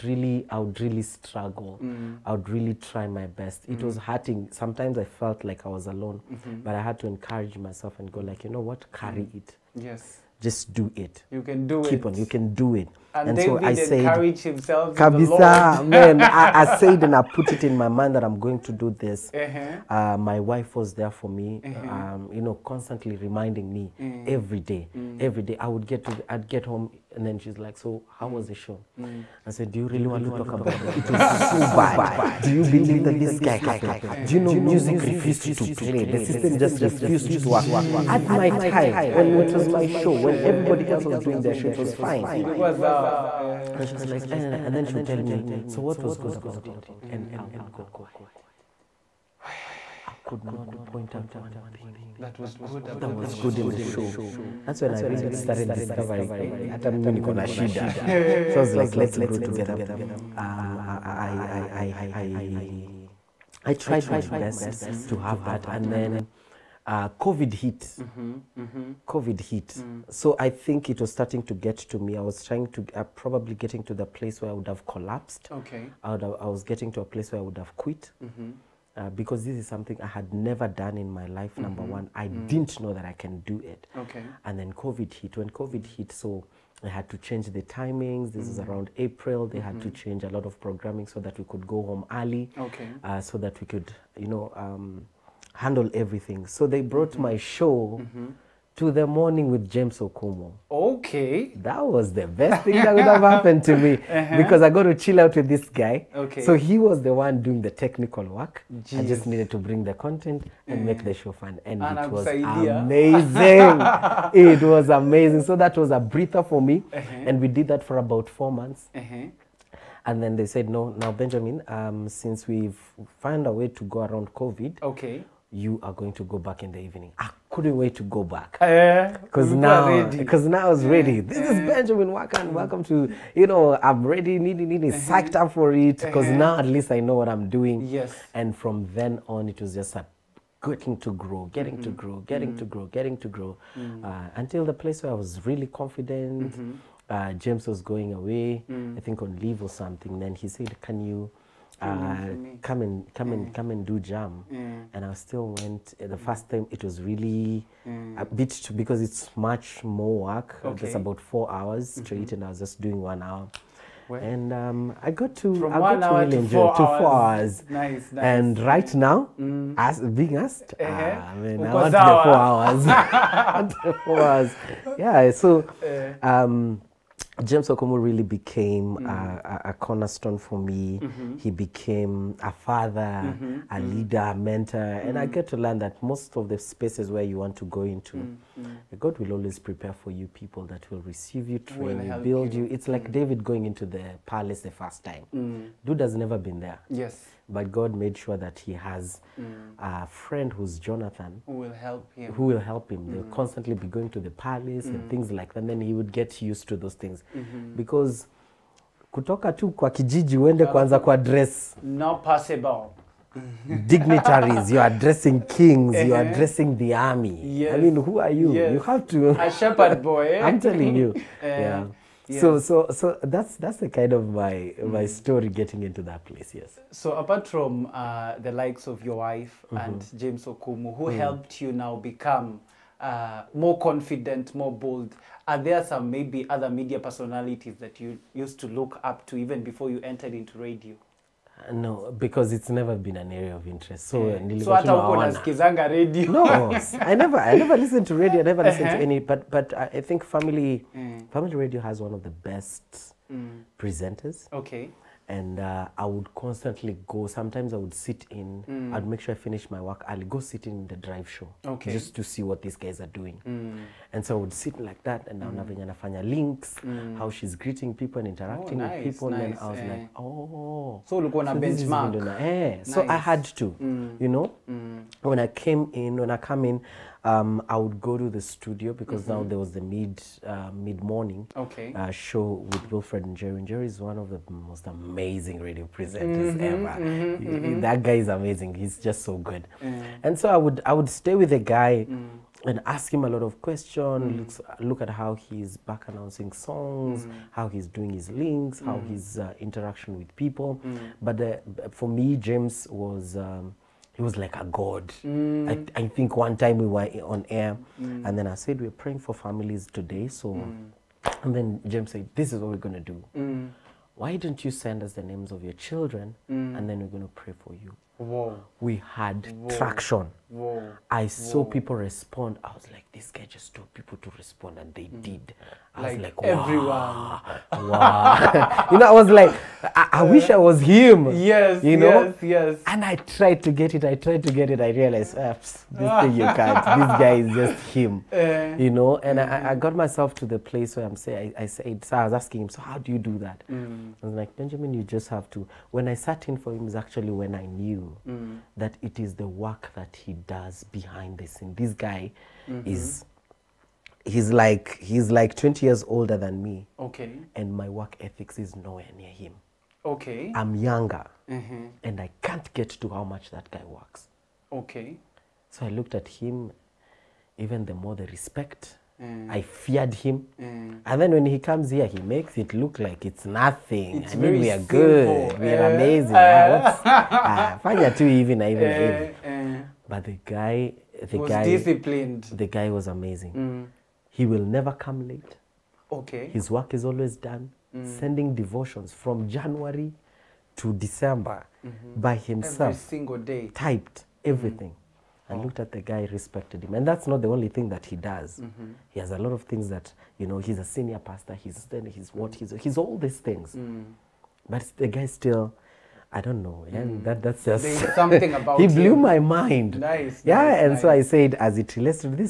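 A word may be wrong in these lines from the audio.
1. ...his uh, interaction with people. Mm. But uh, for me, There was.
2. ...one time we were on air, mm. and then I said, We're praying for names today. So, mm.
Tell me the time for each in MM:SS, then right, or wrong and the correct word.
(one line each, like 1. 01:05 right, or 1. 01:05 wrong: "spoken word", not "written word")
1. 04:59 wrong: "James", not "There"
2. 05:06 wrong: "families", not "names".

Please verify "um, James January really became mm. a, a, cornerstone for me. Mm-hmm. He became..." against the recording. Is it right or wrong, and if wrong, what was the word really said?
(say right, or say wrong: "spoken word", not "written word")
wrong: "Okumu", not "January".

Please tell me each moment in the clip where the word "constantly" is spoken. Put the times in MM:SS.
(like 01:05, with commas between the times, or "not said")
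00:22, 03:23, 04:16.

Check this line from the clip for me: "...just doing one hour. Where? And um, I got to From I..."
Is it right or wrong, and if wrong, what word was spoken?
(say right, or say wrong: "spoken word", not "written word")
right.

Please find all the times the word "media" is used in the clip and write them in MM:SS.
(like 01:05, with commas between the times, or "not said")
03:56.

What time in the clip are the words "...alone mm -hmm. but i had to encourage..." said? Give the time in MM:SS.
00:05.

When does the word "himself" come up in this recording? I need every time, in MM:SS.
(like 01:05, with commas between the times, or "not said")
00:14, 06:32.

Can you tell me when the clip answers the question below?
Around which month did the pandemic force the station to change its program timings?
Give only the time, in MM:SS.
01:28.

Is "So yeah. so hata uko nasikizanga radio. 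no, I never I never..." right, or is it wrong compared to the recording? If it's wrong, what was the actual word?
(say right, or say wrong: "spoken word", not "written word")
right.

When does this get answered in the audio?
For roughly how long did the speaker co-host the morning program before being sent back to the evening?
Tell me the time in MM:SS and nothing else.
01:58.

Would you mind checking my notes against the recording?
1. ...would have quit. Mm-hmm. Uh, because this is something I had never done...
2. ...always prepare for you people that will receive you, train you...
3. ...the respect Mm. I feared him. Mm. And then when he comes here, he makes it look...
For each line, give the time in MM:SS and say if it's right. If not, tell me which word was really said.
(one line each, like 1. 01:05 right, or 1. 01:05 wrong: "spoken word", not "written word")
1. 01:17 right
2. 03:09 right
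3. 06:08 right.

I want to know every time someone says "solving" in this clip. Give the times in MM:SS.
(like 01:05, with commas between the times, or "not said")
not said.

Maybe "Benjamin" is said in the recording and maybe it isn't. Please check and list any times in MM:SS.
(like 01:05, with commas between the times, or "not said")
02:01, 02:11, 05:44.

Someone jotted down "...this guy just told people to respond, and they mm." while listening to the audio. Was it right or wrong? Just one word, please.
right.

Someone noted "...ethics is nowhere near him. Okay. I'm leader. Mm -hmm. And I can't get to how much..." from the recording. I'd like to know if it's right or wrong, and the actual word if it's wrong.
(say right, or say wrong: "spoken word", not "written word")
wrong: "younger", not "leader".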